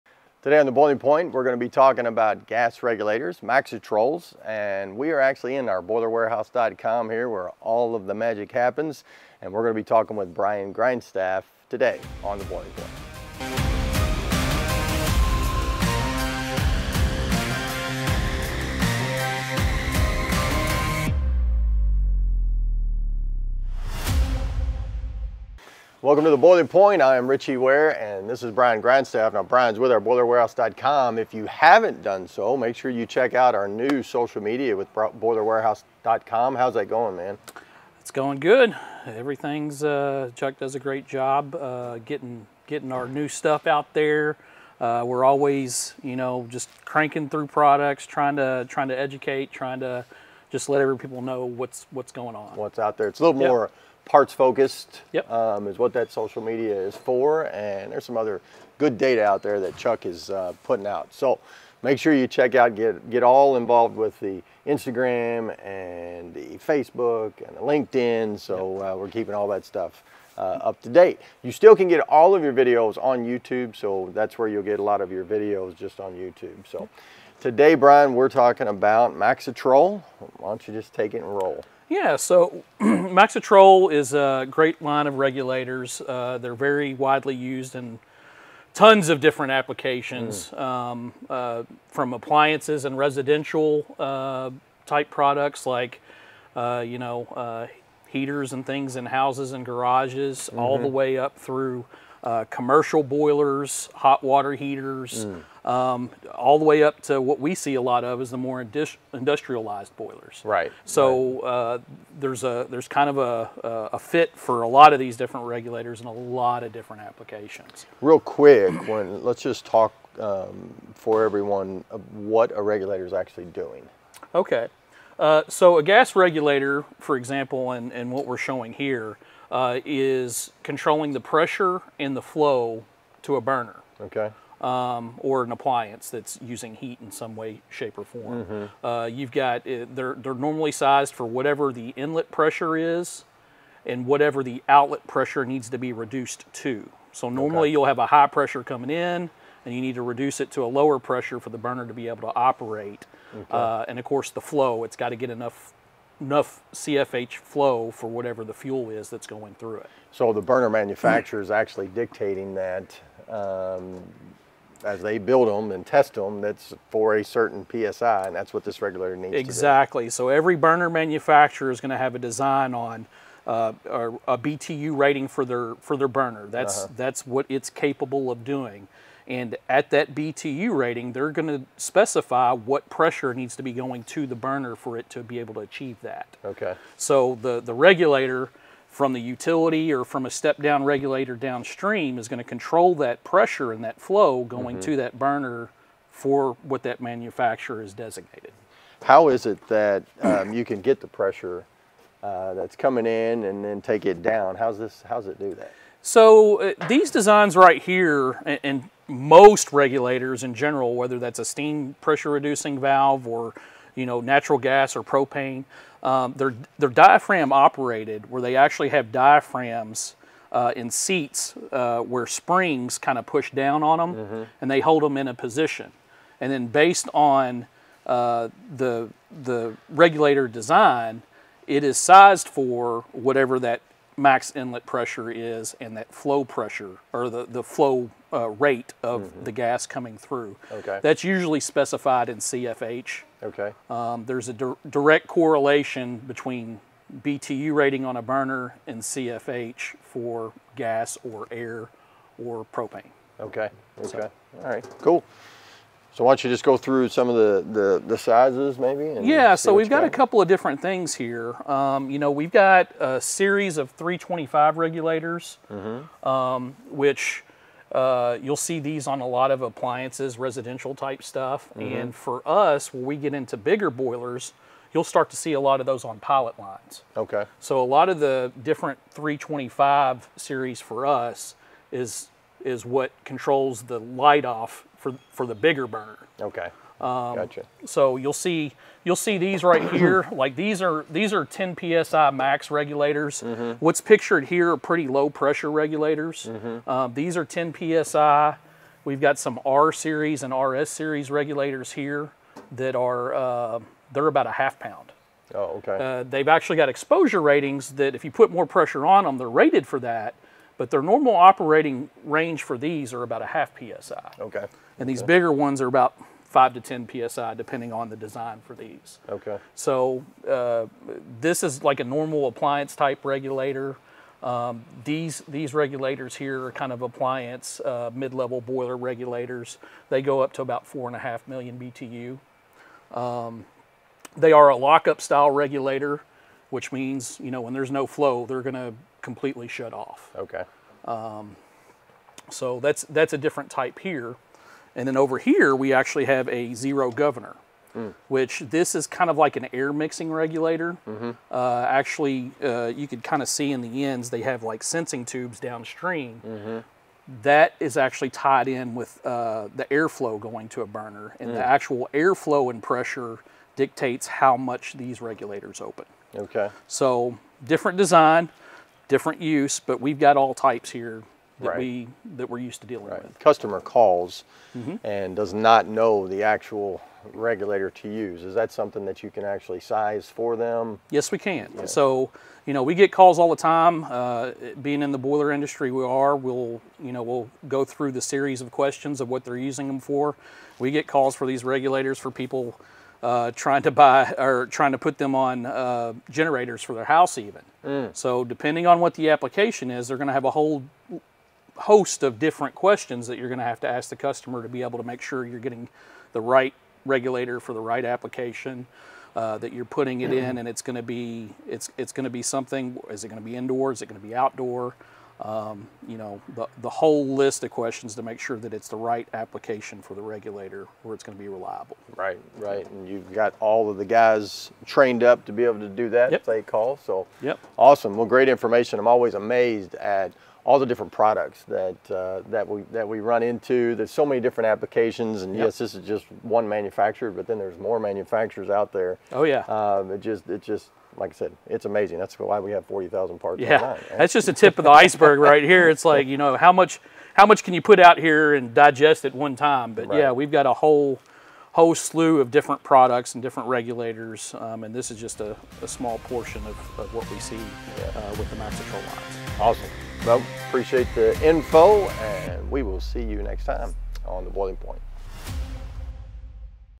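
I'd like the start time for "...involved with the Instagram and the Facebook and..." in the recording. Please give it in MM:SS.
01:03.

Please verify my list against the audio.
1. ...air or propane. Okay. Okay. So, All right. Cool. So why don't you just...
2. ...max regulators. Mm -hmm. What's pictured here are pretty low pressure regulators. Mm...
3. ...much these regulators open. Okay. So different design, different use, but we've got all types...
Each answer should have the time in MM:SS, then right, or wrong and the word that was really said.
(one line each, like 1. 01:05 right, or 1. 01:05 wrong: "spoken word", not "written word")
1. 04:11 right
2. 04:52 right
3. 06:04 right.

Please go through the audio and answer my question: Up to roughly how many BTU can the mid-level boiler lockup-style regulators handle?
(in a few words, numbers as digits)
4.5 million BTU.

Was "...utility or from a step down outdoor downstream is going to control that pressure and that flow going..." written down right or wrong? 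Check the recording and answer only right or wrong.
wrong.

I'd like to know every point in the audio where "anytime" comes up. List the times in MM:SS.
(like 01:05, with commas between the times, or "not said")
not said.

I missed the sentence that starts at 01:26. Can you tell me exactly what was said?
Uh, they're very widely used in tons of different applications, mm.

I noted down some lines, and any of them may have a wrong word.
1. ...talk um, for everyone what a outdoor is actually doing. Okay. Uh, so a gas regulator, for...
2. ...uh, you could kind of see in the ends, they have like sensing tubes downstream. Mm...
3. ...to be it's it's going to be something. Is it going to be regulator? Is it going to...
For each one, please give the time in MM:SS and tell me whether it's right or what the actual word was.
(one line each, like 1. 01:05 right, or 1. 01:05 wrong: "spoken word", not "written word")
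1. 01:59 wrong: "regulator", not "outdoor"
2. 05:52 right
3. 06:50 wrong: "indoor", not "regulator".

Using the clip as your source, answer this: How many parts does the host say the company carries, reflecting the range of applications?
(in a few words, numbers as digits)
40,000.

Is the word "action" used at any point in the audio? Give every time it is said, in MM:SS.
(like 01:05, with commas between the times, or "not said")
not said.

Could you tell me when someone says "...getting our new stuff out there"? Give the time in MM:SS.
00:42.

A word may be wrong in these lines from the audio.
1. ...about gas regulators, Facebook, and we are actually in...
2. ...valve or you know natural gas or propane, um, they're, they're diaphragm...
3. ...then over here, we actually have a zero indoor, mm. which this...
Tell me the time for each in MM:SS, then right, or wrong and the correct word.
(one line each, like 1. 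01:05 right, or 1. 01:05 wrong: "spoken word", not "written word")
1. 00:02 wrong: "Maxitrols", not "Facebook"
2. 03:32 right
3. 05:45 wrong: "governor", not "indoor".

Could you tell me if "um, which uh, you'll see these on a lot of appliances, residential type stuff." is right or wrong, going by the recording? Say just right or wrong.
right.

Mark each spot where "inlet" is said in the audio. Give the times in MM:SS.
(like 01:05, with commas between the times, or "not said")
02:21, 03:54.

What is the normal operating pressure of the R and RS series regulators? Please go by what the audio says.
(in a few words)
half psi.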